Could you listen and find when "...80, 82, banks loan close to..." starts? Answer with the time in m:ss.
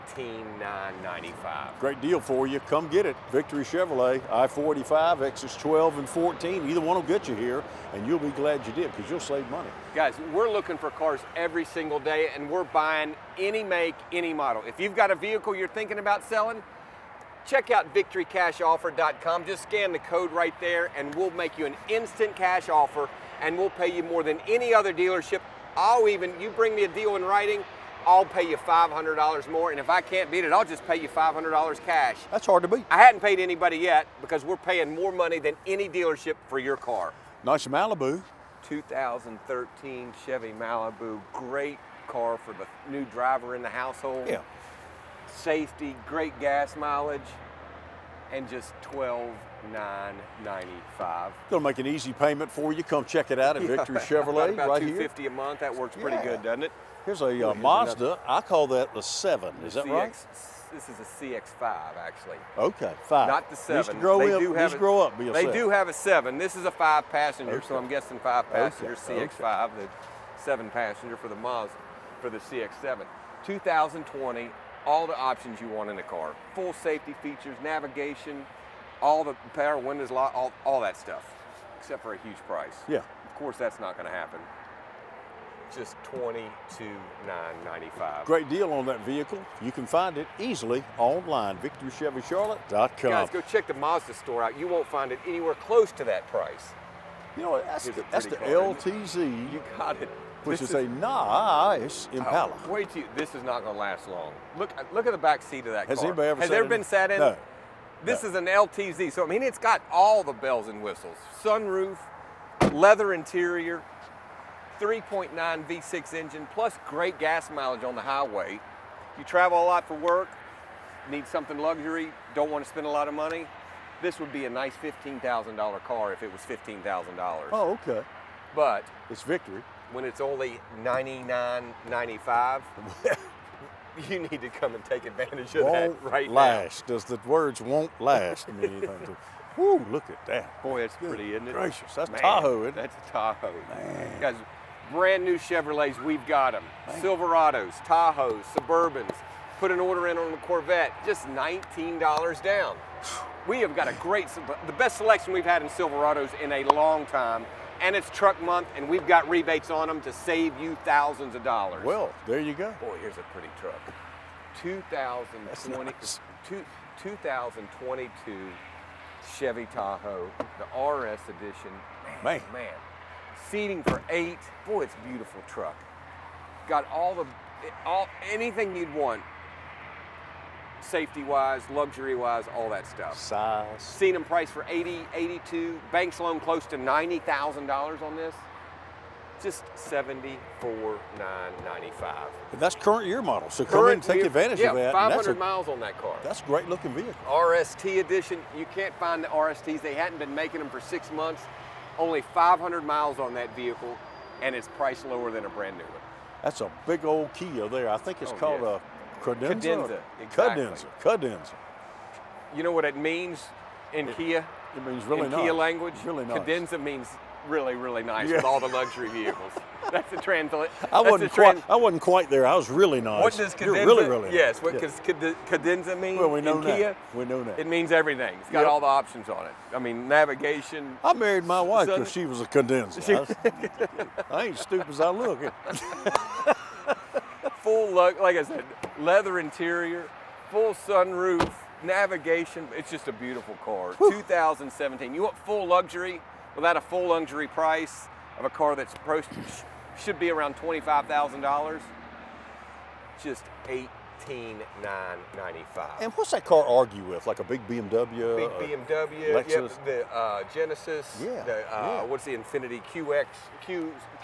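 3:04.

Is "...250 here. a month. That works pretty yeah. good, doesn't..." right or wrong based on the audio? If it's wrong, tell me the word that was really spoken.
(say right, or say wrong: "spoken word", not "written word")
right.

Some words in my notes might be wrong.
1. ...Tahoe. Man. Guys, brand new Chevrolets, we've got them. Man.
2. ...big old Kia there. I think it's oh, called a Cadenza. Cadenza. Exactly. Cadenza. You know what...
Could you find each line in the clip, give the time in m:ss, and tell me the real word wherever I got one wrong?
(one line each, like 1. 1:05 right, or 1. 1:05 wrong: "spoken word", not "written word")
1. 2:23 right
2. 3:26 right.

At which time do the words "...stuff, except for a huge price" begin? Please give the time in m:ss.
1:20.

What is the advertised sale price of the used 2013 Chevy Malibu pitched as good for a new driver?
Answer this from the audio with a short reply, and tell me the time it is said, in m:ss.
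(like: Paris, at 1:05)
$12,995, at 0:48.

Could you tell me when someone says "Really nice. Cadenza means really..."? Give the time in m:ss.
3:36.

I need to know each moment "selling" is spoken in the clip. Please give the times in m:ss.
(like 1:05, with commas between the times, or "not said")
0:16.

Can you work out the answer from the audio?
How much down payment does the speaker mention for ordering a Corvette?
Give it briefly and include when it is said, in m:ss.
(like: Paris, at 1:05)
$19, at 2:31.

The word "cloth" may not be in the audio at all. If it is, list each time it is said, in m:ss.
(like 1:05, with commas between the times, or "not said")
not said.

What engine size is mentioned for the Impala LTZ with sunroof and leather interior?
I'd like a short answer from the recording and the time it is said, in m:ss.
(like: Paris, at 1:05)
3.9 V6, at 1:54.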